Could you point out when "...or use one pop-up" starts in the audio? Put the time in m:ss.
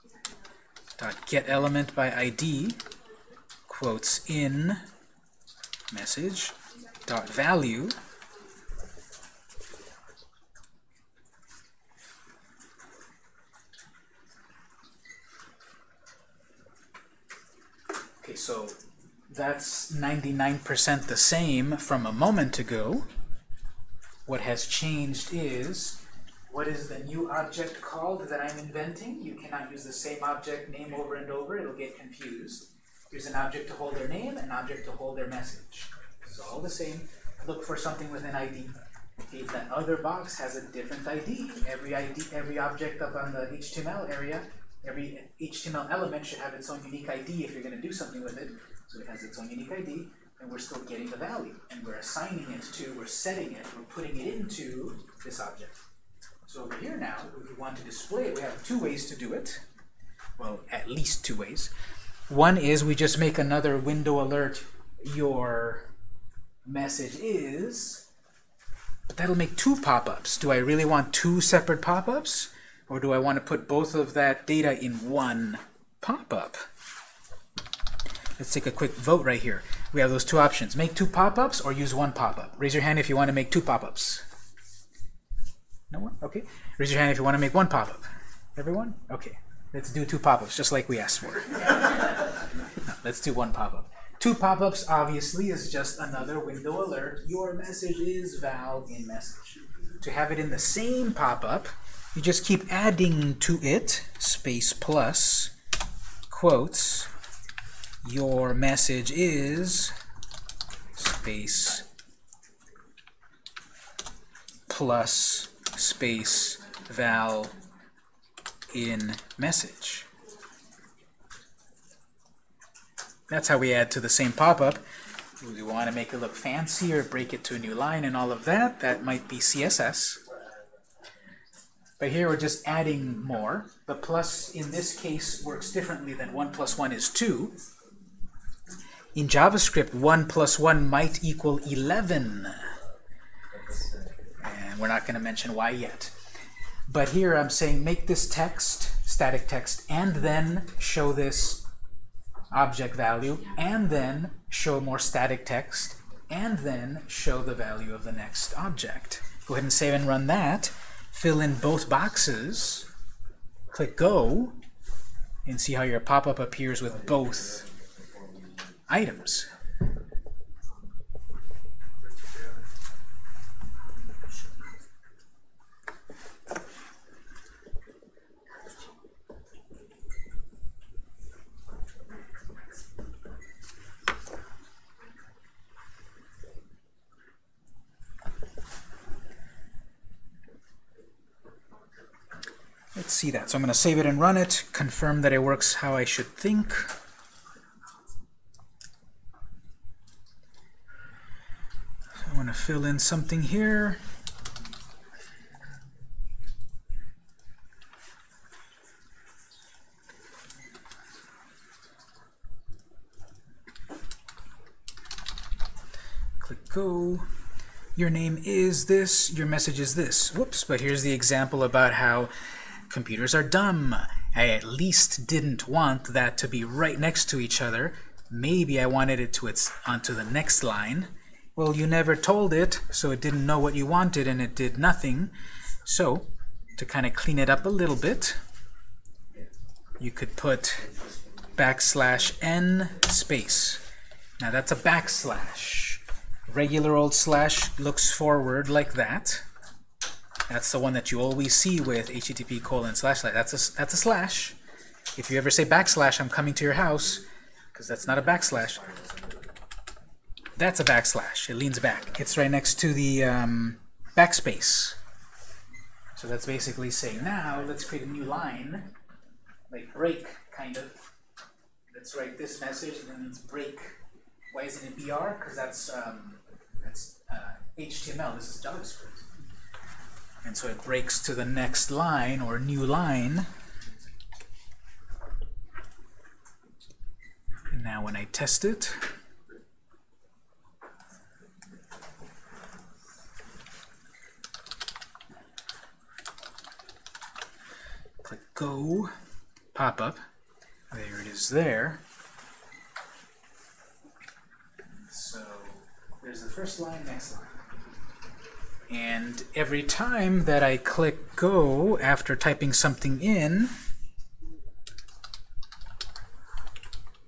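1:21.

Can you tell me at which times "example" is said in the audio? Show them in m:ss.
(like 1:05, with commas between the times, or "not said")
3:41.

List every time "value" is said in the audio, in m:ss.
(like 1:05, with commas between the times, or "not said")
0:07, 0:51, 2:32, 2:37.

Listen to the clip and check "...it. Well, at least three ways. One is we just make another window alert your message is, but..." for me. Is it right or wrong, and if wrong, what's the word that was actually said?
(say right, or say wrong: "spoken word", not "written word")
wrong: "two", not "three".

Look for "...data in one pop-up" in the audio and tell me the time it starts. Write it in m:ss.
1:14.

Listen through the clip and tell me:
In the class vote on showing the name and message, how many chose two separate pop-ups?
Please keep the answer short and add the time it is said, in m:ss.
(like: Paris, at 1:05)
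No one, at 1:25.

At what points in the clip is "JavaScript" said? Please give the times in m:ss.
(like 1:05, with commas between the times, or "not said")
2:19, 4:38.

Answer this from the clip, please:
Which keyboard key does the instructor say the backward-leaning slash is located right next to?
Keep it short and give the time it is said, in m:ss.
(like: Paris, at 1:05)
backspace, at 4:24.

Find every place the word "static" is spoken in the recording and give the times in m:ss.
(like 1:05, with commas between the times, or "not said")
2:29, 2:34.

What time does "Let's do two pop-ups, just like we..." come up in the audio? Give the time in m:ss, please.
1:29.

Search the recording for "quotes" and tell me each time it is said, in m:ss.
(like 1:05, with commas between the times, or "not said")
0:03, 1:46.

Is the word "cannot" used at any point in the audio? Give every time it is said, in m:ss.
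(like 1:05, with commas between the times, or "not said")
0:29.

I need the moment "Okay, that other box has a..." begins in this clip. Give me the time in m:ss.
0:39.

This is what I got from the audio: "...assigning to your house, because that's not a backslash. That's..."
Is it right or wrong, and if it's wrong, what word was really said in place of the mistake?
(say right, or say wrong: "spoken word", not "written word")
wrong: "coming", not "assigning".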